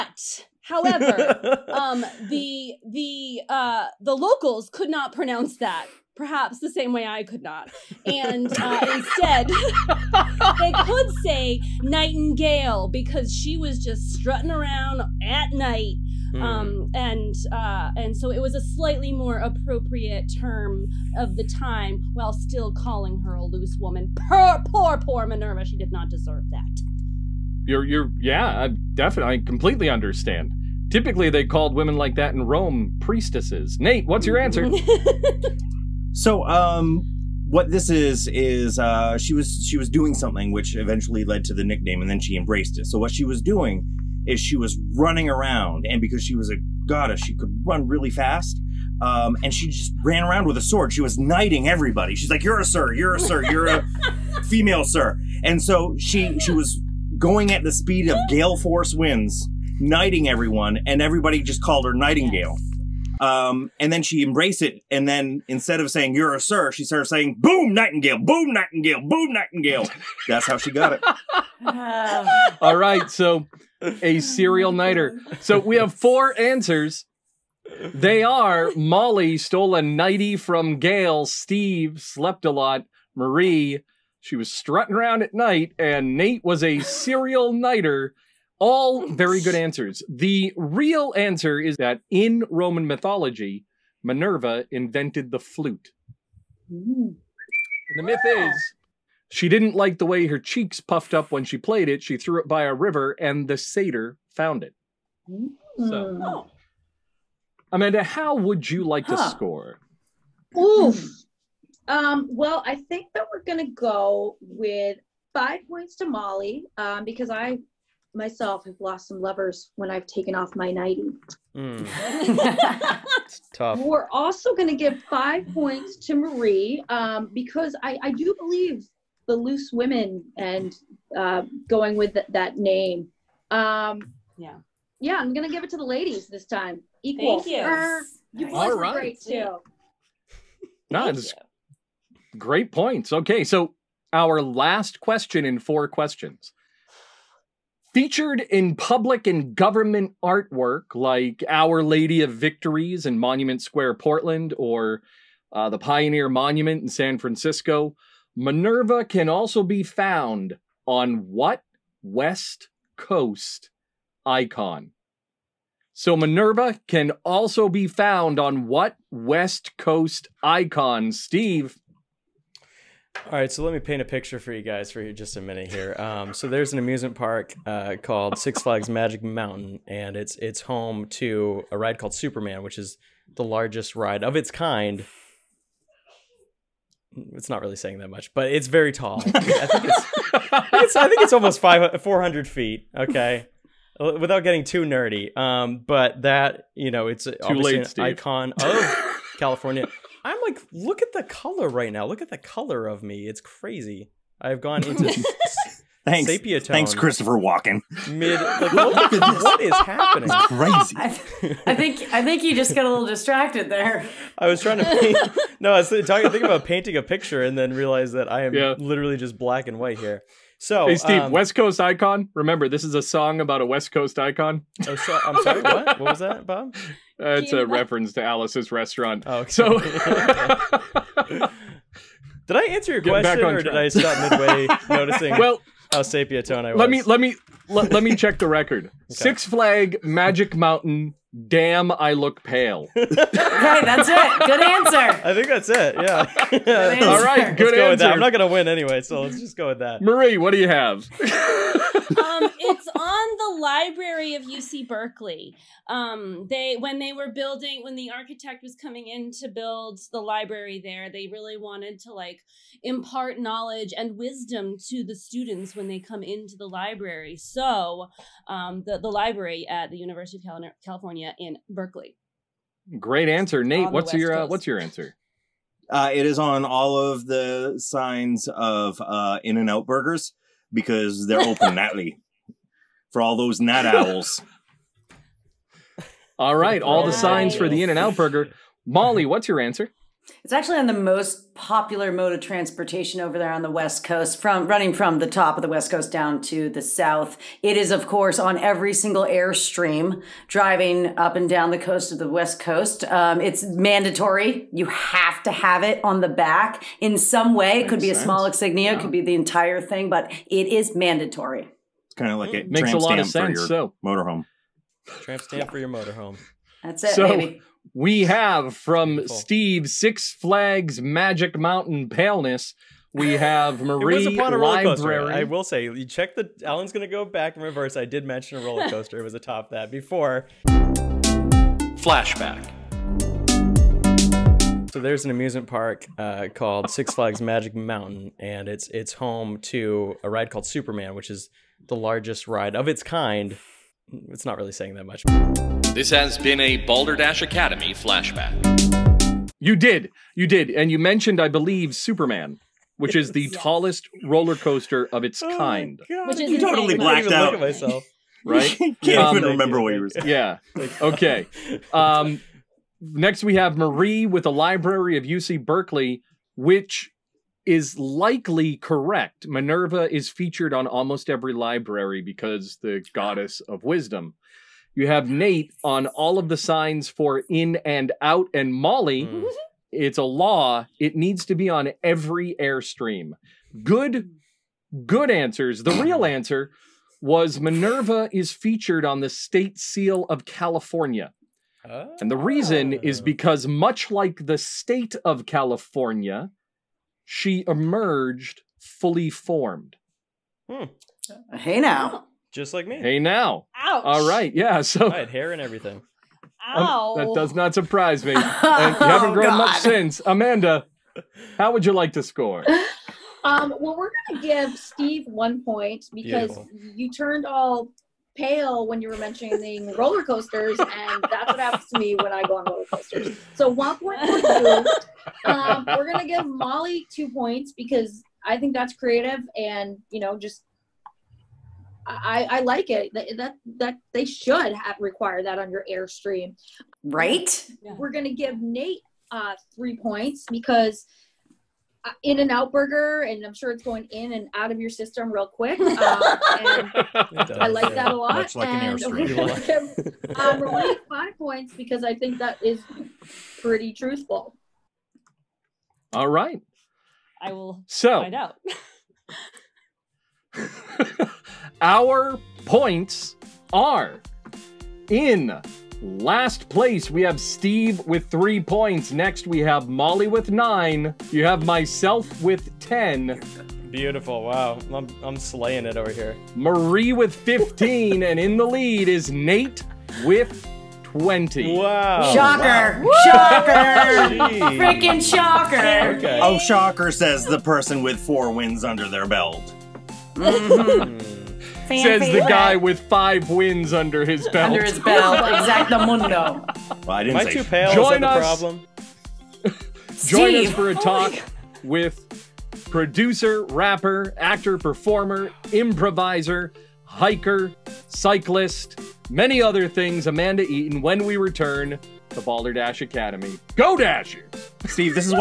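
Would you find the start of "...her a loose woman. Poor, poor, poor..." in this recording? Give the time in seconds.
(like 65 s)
23 s.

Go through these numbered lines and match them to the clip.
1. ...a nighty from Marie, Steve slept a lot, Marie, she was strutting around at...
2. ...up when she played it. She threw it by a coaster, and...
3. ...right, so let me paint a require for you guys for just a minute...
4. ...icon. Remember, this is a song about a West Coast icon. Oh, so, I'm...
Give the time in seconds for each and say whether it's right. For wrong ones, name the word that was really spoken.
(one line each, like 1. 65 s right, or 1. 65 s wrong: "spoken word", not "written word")
1. 79 s wrong: "Gail", not "Marie"
2. 101 s wrong: "river", not "coaster"
3. 173 s wrong: "picture", not "require"
4. 221 s right.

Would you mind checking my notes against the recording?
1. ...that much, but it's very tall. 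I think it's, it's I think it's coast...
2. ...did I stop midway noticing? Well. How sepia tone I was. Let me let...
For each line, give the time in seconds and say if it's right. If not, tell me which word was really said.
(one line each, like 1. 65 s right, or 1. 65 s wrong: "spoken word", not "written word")
1. 187 s wrong: "almost", not "coast"
2. 233 s right.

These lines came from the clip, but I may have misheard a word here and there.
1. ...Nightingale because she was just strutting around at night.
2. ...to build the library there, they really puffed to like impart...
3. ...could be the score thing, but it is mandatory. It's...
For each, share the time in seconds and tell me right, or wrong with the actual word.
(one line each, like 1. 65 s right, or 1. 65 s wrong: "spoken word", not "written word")
1. 11 s right
2. 259 s wrong: "wanted", not "puffed"
3. 309 s wrong: "entire", not "score".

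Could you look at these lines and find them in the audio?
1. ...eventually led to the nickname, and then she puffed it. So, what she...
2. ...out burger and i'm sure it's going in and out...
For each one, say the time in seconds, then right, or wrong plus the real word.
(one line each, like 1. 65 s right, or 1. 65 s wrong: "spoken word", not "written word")
1. 40 s wrong: "embraced", not "puffed"
2. 442 s right.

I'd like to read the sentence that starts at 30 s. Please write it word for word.
Typically, they called women like that in Rome priestesses.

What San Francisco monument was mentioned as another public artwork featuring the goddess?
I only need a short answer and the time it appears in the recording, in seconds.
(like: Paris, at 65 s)
Pioneer Monument, at 155 s.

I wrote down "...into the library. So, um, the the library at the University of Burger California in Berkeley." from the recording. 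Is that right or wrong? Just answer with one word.
wrong.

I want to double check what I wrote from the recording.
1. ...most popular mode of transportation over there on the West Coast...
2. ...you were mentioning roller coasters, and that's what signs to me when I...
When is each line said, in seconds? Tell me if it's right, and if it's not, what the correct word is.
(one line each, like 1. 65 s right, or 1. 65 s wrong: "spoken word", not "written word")
1. 290 s right
2. 419 s wrong: "happens", not "signs".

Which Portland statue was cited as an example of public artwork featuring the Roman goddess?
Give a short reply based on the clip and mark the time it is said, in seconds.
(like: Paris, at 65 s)
Our Lady of Victories, at 151 s.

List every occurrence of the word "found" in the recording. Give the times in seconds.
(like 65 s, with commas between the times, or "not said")
104 s, 159 s, 167 s.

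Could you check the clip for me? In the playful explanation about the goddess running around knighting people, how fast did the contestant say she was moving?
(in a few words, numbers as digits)
gale force winds.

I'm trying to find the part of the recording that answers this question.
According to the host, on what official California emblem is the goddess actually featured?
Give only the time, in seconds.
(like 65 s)
389 s.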